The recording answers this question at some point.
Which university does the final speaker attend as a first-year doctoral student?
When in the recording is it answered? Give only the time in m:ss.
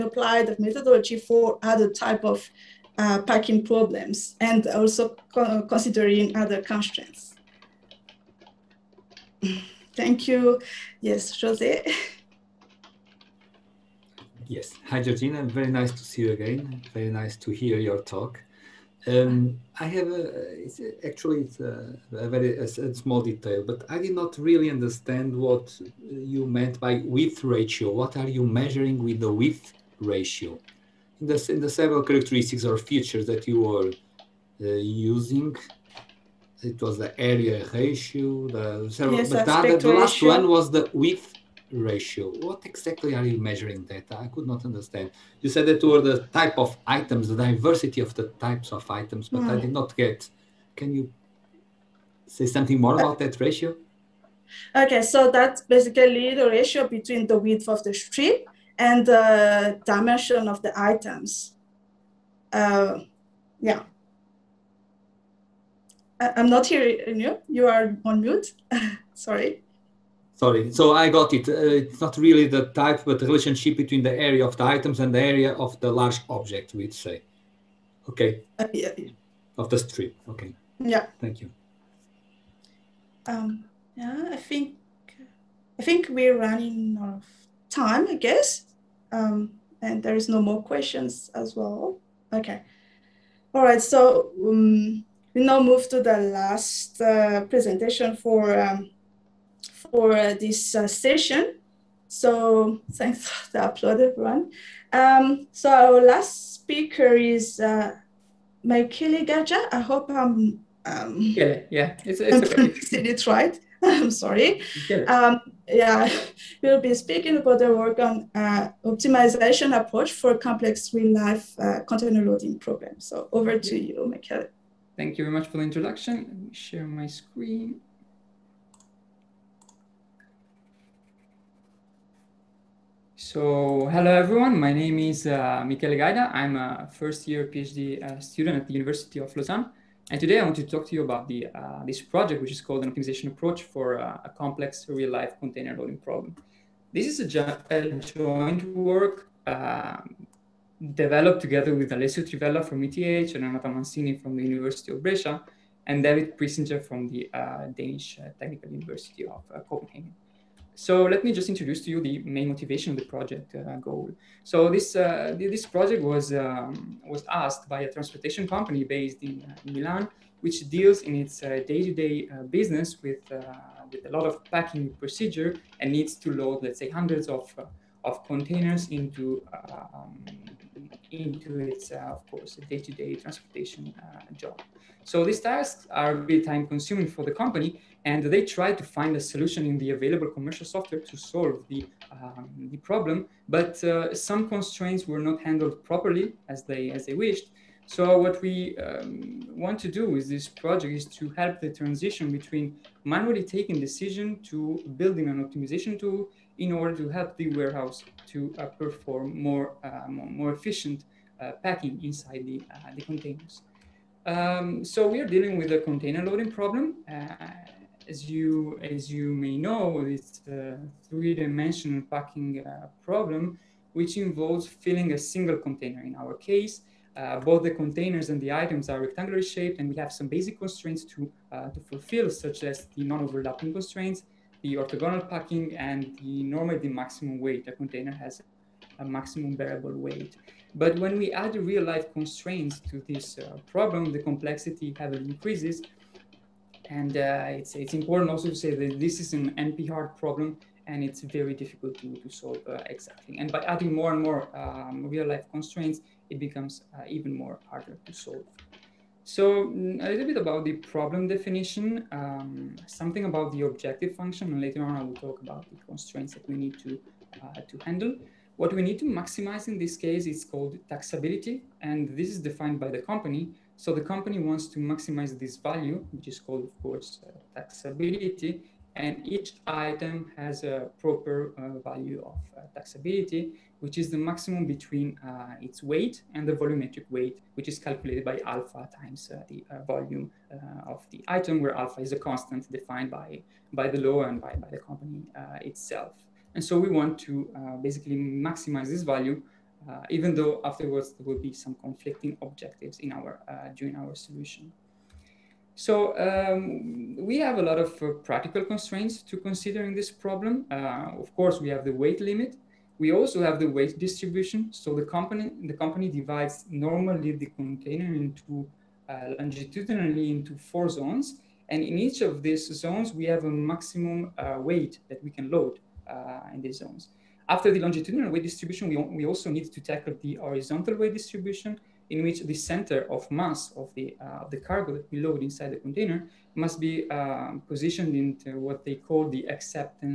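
2:18.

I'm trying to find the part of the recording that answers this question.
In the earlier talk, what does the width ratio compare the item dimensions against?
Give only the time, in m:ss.
0:57.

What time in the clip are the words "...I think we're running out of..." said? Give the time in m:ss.
1:25.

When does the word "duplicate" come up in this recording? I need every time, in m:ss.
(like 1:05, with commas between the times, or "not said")
not said.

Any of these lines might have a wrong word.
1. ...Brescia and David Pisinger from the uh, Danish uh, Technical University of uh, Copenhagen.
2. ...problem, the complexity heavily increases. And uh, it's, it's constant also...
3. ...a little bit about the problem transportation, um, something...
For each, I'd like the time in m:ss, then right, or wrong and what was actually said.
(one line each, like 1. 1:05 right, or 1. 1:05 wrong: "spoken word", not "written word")
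1. 2:35 right
2. 4:03 wrong: "important", not "constant"
3. 4:20 wrong: "definition", not "transportation".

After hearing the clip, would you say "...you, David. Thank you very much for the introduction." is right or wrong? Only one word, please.
wrong.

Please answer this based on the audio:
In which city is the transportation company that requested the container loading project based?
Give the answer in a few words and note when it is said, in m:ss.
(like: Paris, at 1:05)
Milan, at 2:49.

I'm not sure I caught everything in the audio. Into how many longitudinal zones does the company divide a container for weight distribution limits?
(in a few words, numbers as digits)
4.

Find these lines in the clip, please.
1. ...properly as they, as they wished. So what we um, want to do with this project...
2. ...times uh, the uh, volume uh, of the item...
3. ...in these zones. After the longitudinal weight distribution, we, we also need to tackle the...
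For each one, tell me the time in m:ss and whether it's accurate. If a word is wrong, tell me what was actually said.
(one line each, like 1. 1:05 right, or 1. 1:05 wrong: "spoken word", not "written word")
1. 3:15 right
2. 4:48 right
3. 5:26 right.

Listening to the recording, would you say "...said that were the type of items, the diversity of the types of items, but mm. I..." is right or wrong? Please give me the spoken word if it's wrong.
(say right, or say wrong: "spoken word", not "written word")
right.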